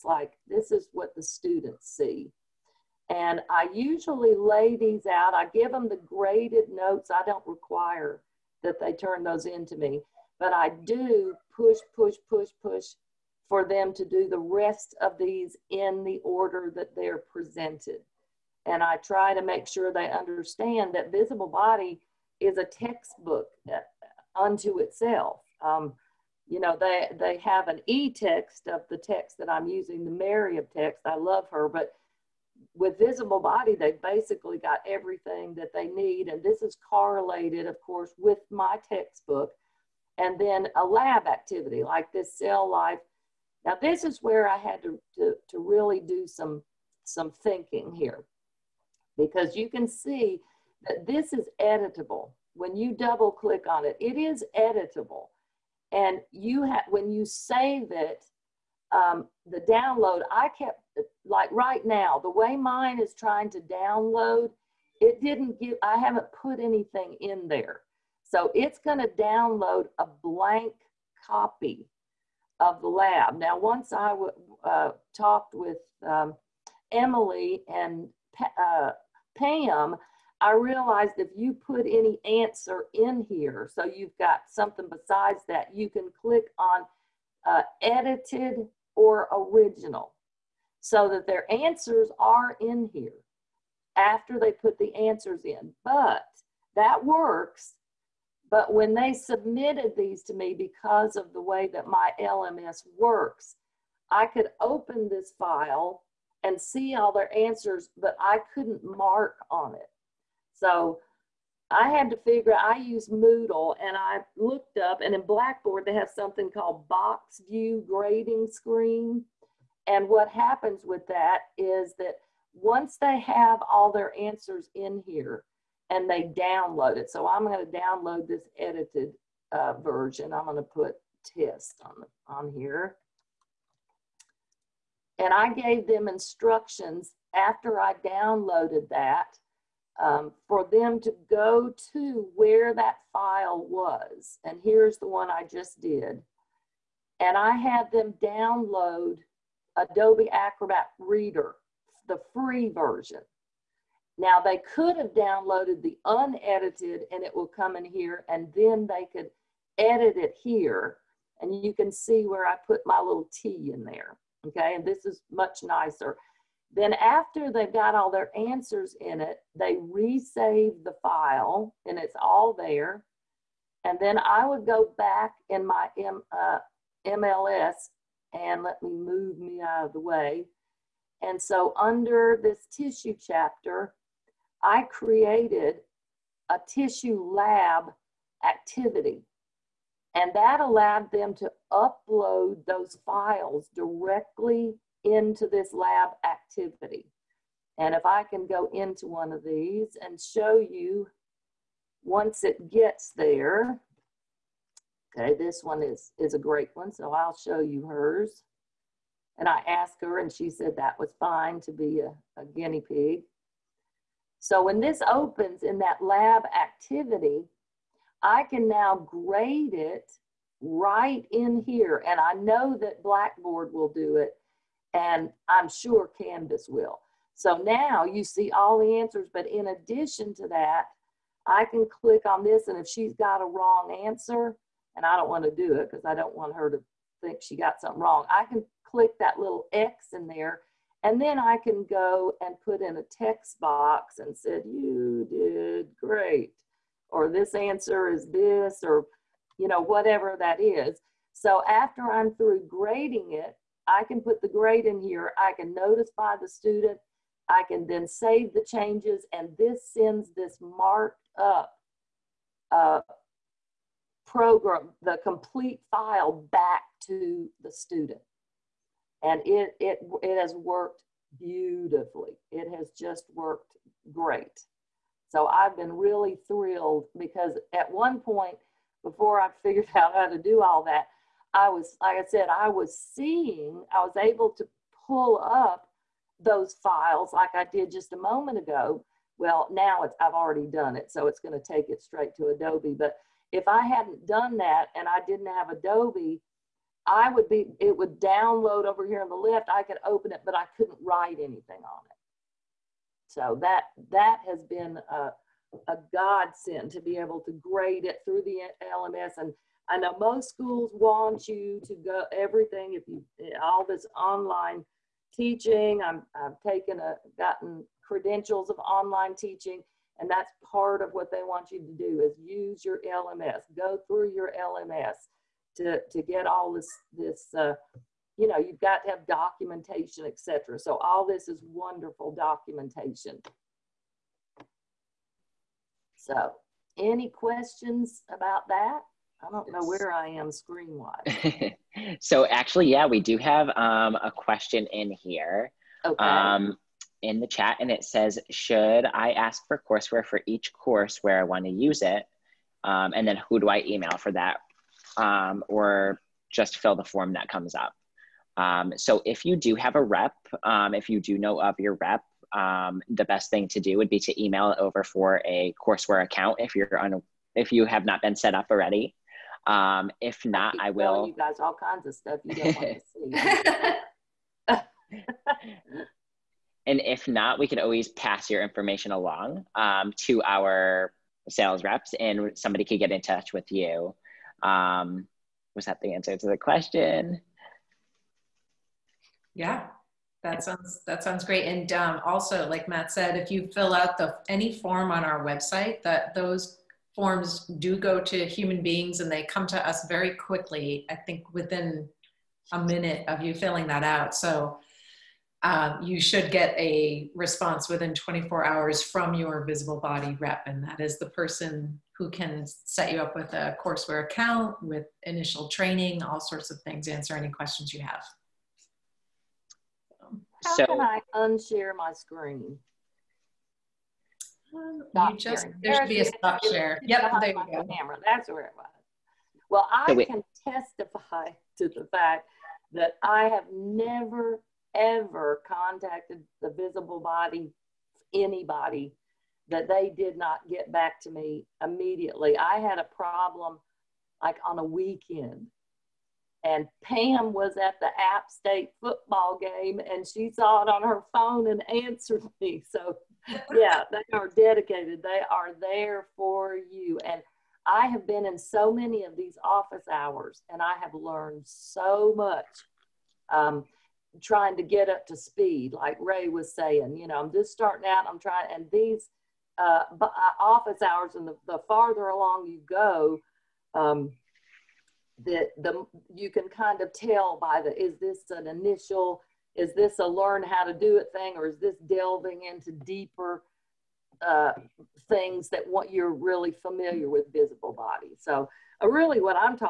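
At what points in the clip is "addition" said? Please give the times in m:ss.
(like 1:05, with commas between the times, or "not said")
3:49.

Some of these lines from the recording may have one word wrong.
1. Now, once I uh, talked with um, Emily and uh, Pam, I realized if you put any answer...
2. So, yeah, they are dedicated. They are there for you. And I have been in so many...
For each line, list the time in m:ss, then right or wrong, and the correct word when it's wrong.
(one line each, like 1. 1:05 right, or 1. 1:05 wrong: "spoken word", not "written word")
1. 1:13 right
2. 7:32 right.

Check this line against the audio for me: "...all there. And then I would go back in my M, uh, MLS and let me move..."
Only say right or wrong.
right.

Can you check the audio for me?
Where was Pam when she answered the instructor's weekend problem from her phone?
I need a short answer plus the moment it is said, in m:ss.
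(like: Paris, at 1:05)
App State football game, at 7:28.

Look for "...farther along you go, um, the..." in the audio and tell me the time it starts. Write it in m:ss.
7:51.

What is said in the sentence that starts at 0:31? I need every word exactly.
I love her, but with visible body, they basically got everything that they need.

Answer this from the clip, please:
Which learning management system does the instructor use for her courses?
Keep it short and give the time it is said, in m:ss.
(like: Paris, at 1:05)
Moodle, at 1:53.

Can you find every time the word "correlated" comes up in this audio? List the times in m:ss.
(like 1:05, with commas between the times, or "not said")
0:36.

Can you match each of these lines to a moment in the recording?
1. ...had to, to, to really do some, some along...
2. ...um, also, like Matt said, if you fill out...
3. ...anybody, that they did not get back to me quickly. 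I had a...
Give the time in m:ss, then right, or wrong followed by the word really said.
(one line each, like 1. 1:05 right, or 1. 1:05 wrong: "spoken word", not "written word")
1. 0:44 wrong: "thinking", not "along"
2. 6:31 right
3. 7:18 wrong: "immediately", not "quickly".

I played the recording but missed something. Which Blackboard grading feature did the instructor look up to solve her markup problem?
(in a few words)
box view grading screen.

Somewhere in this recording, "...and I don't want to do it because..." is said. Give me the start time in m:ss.
3:54.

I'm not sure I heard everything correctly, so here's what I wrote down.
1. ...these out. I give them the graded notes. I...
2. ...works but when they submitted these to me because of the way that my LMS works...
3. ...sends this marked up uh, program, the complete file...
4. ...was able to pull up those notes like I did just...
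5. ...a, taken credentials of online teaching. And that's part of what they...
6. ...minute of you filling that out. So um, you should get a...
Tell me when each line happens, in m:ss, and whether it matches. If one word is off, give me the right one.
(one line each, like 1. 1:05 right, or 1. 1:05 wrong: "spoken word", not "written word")
1. 0:04 right
2. 1:37 right
3. 4:19 right
4. 4:44 wrong: "files", not "notes"
5. 5:16 wrong: "gotten", not "taken"
6. 6:42 right.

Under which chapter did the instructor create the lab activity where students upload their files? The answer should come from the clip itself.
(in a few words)
tissue chapter.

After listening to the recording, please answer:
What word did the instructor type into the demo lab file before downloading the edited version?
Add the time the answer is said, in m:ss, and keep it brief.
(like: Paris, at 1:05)
test, at 2:11.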